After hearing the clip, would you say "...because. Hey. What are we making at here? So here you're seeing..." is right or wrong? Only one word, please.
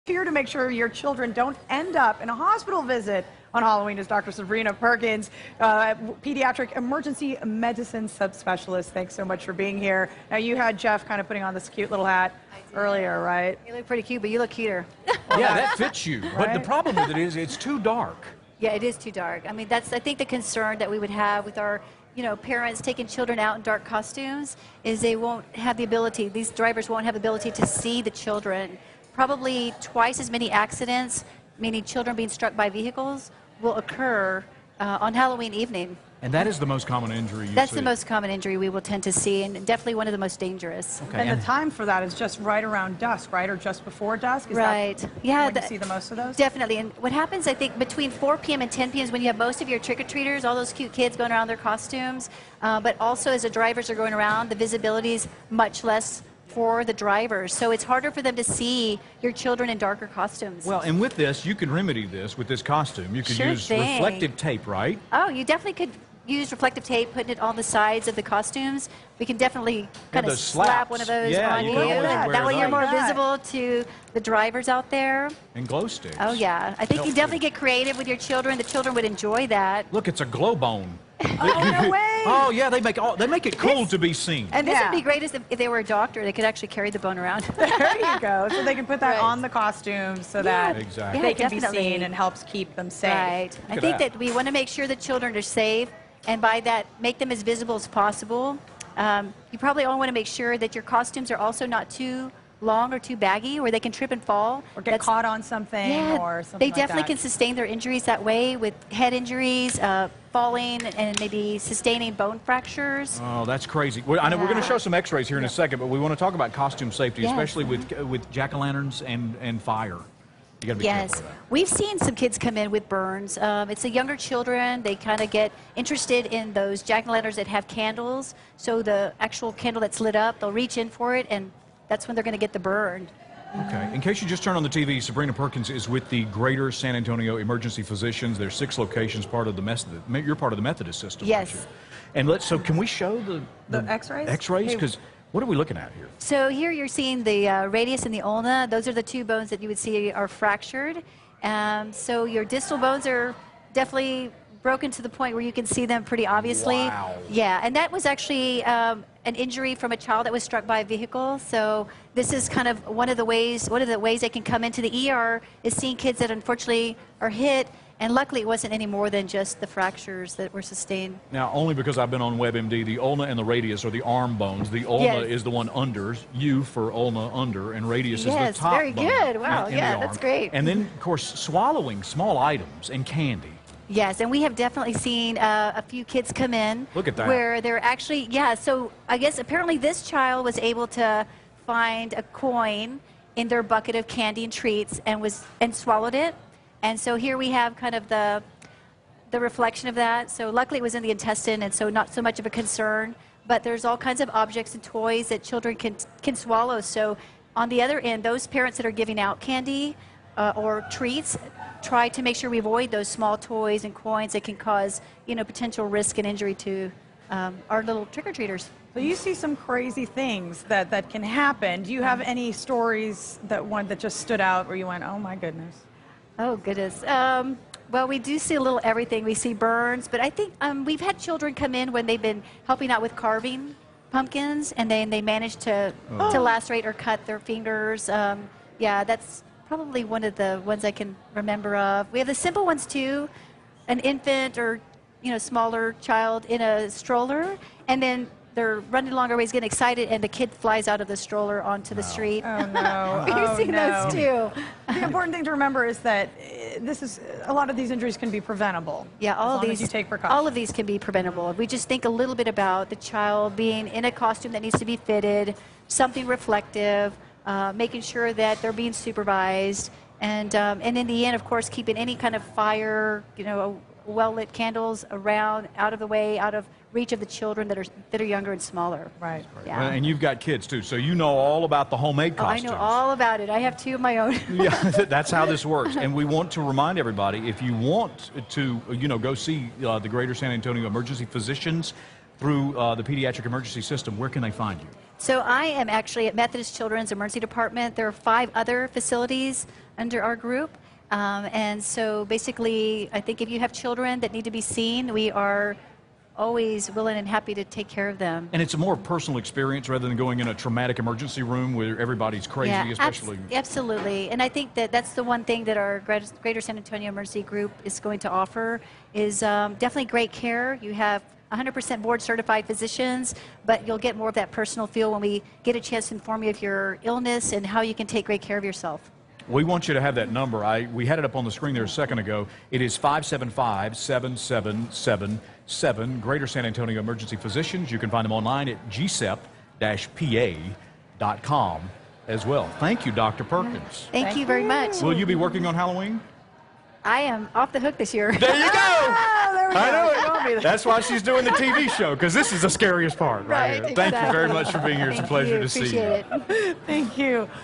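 wrong.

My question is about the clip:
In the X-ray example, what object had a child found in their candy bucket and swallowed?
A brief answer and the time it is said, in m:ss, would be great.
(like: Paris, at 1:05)
A coin, at 3:12.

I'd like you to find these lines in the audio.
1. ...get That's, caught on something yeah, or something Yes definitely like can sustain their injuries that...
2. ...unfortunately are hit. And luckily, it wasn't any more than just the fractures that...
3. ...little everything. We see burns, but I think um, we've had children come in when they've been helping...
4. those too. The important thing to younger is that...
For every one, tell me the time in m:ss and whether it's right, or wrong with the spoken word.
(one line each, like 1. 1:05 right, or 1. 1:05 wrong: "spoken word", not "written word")
1. 1:44 wrong: "They", not "Yes"
2. 2:46 right
3. 3:48 right
4. 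4:14 wrong: "remember", not "younger".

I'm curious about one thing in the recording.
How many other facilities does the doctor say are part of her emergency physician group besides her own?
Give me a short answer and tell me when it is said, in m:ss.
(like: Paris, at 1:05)
5, at 4:58.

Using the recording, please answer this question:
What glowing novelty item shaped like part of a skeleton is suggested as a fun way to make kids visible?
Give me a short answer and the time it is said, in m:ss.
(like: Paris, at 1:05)
A glow bone, at 1:20.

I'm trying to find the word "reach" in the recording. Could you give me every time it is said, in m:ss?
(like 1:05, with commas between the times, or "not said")
2:10, 4:36.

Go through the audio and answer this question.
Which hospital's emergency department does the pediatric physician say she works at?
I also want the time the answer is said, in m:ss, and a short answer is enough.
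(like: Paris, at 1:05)
Methodist Children's, at 4:56.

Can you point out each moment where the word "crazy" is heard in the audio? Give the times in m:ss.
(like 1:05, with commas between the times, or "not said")
1:53, 3:39, 5:12.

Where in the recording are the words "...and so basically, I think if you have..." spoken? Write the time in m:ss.
5:01.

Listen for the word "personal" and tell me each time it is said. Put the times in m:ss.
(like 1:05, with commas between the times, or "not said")
5:08, 5:24.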